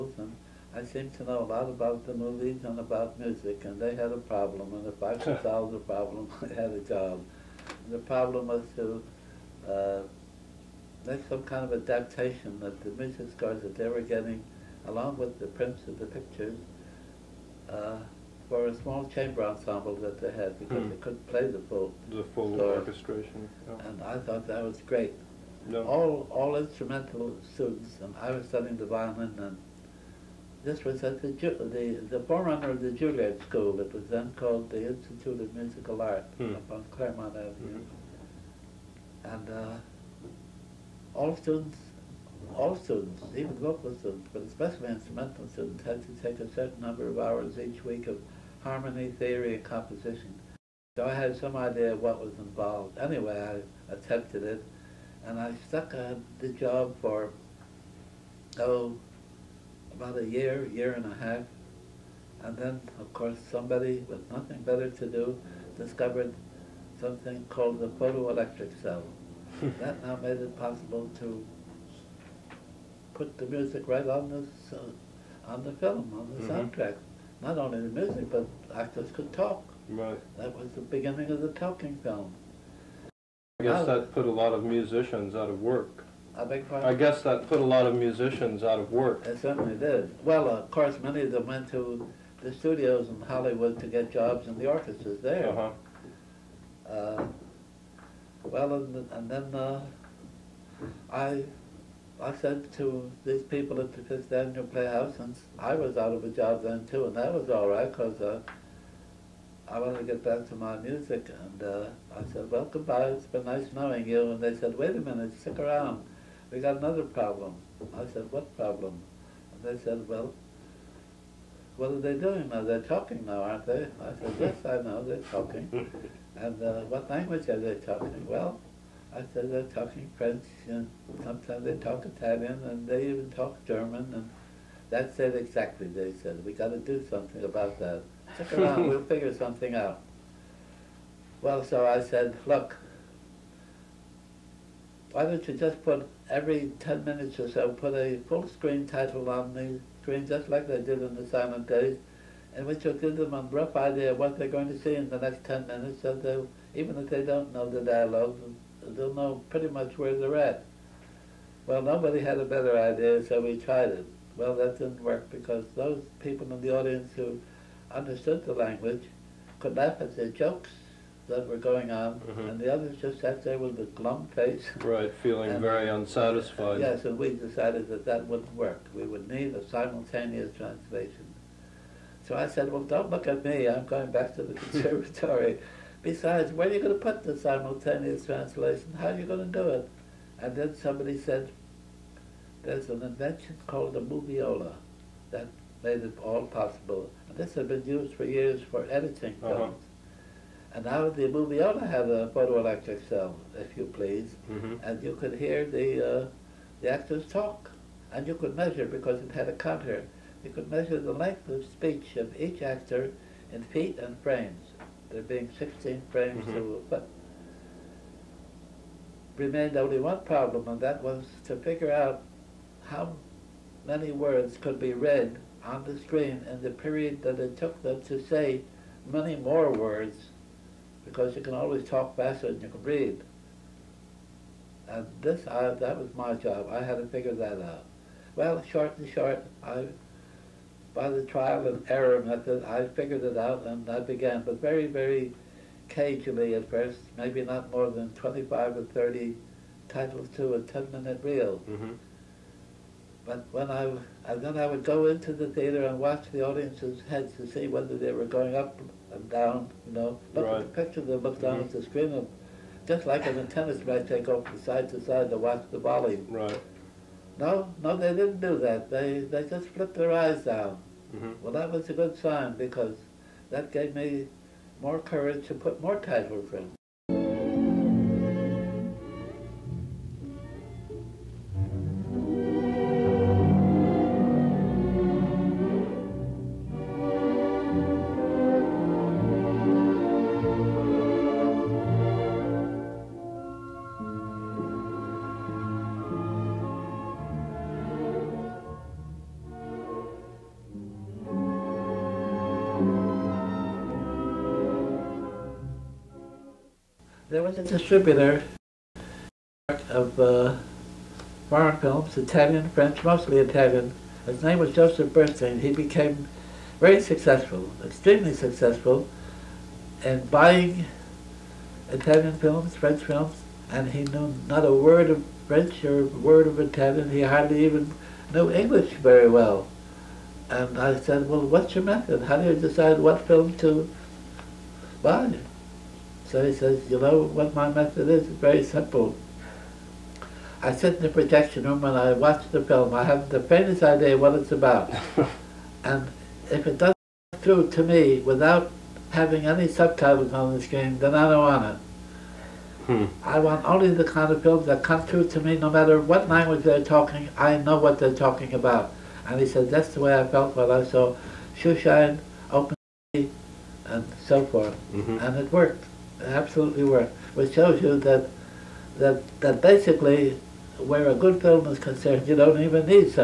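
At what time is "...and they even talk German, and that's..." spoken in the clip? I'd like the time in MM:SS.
02:12.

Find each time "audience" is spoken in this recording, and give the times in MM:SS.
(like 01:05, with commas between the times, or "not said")
02:46, 04:16.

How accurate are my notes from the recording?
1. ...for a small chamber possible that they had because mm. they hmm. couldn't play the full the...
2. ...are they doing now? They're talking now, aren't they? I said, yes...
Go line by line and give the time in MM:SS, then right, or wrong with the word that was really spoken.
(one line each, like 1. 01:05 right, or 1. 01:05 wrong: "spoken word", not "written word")
1. 00:18 wrong: "ensemble", not "possible"
2. 02:01 right.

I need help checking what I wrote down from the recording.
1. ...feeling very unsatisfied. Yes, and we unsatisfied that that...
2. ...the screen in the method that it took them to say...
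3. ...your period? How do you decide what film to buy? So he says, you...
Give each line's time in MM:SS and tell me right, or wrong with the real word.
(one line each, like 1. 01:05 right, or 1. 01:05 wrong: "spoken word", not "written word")
1. 02:55 wrong: "decided", not "unsatisfied"
2. 03:45 wrong: "period", not "method"
3. 05:31 wrong: "method", not "period".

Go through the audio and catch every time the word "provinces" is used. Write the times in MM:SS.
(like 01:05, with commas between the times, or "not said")
not said.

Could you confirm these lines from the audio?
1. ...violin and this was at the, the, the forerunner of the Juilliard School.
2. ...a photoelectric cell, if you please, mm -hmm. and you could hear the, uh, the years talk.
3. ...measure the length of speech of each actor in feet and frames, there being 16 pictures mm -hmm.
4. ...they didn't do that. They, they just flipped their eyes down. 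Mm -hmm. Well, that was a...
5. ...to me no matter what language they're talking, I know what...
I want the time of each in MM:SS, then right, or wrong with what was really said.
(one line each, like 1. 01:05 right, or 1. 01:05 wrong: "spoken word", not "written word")
1. 00:28 right
2. 03:22 wrong: "actors", not "years"
3. 03:30 wrong: "frames", not "pictures"
4. 04:27 right
5. 05:55 right.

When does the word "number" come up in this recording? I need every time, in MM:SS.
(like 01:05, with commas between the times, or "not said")
00:46.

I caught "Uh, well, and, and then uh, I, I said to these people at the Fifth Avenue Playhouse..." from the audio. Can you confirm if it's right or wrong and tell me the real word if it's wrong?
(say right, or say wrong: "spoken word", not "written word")
right.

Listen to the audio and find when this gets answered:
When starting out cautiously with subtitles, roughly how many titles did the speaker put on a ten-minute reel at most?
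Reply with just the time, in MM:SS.
04:08.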